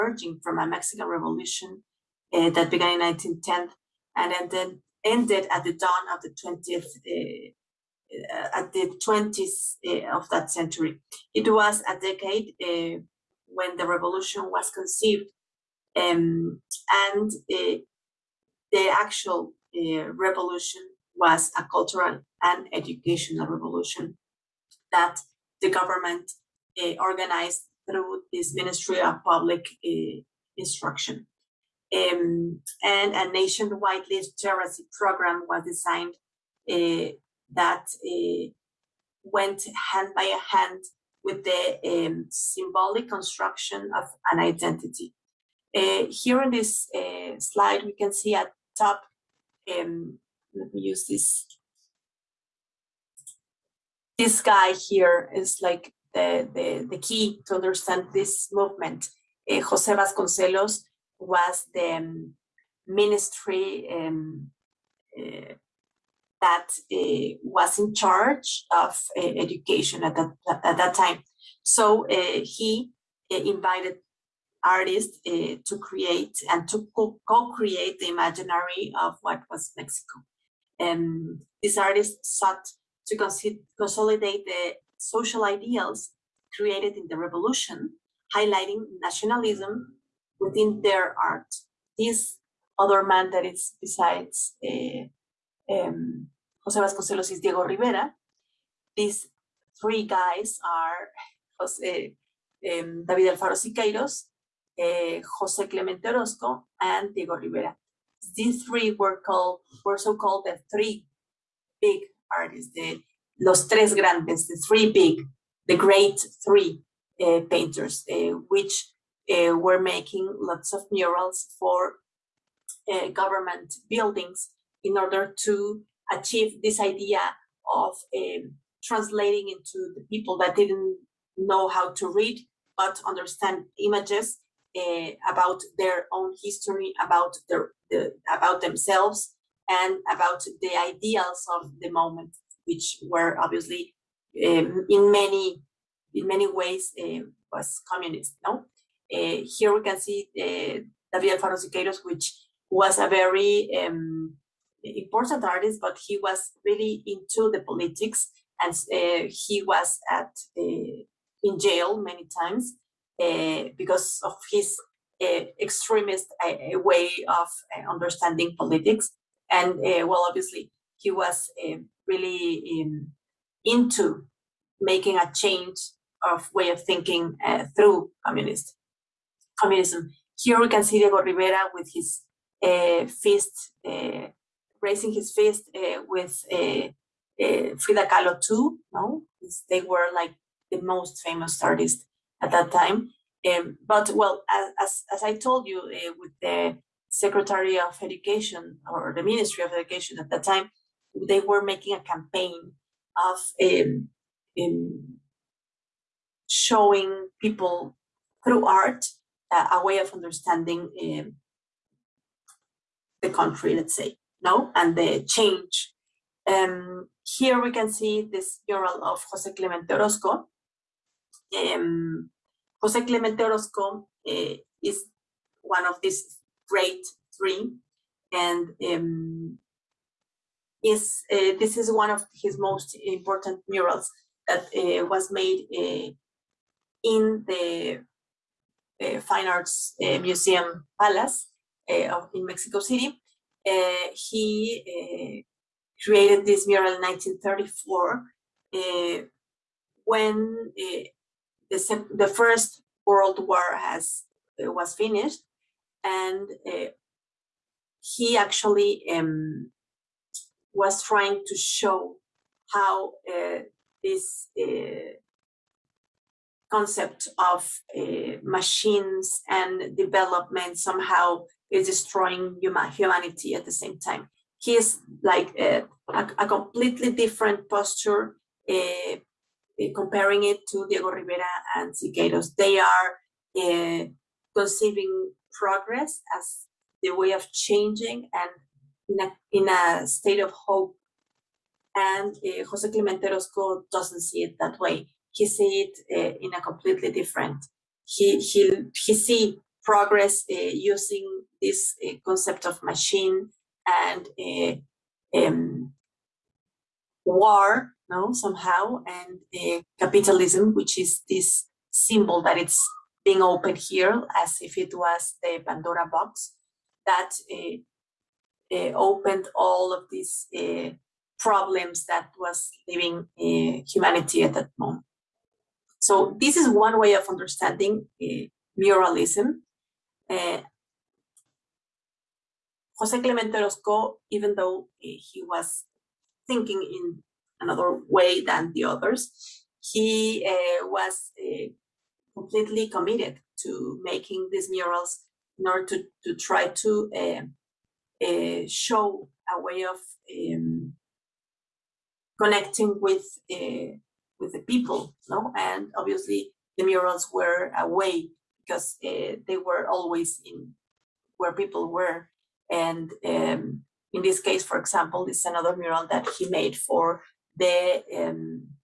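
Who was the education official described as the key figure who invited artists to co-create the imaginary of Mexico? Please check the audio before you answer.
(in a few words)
Jose Vasconcelos.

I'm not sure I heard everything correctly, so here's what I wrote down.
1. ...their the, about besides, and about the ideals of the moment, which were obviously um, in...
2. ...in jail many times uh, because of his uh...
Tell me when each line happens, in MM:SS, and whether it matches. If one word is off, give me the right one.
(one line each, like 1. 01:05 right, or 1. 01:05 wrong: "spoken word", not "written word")
1. 02:17 wrong: "themselves", not "besides"
2. 02:41 right.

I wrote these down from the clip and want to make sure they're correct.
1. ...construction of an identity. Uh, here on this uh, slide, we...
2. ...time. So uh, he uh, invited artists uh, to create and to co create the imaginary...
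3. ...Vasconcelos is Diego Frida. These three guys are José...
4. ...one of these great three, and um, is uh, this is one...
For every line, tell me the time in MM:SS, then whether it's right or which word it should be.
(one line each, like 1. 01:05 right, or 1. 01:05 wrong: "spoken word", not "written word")
1. 00:43 right
2. 01:10 right
3. 01:36 wrong: "Rivera", not "Frida"
4. 03:45 right.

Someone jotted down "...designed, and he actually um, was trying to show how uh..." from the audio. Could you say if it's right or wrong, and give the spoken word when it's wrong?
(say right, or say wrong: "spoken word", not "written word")
wrong: "finished", not "designed".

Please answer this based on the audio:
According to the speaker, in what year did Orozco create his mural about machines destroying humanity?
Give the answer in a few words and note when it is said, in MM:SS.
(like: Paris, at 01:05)
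1934, at 04:06.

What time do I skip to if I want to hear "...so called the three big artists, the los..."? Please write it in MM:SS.
01:49.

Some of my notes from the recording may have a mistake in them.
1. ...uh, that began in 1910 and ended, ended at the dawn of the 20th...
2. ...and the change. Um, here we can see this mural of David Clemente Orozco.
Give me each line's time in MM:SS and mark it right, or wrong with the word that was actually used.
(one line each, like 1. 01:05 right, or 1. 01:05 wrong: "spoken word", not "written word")
1. 00:02 right
2. 03:34 wrong: "Jose", not "David".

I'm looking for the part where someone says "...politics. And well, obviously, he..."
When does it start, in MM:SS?
02:48.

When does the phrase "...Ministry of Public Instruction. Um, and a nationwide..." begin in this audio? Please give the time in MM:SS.
00:28.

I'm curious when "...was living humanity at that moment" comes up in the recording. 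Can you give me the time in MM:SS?
05:22.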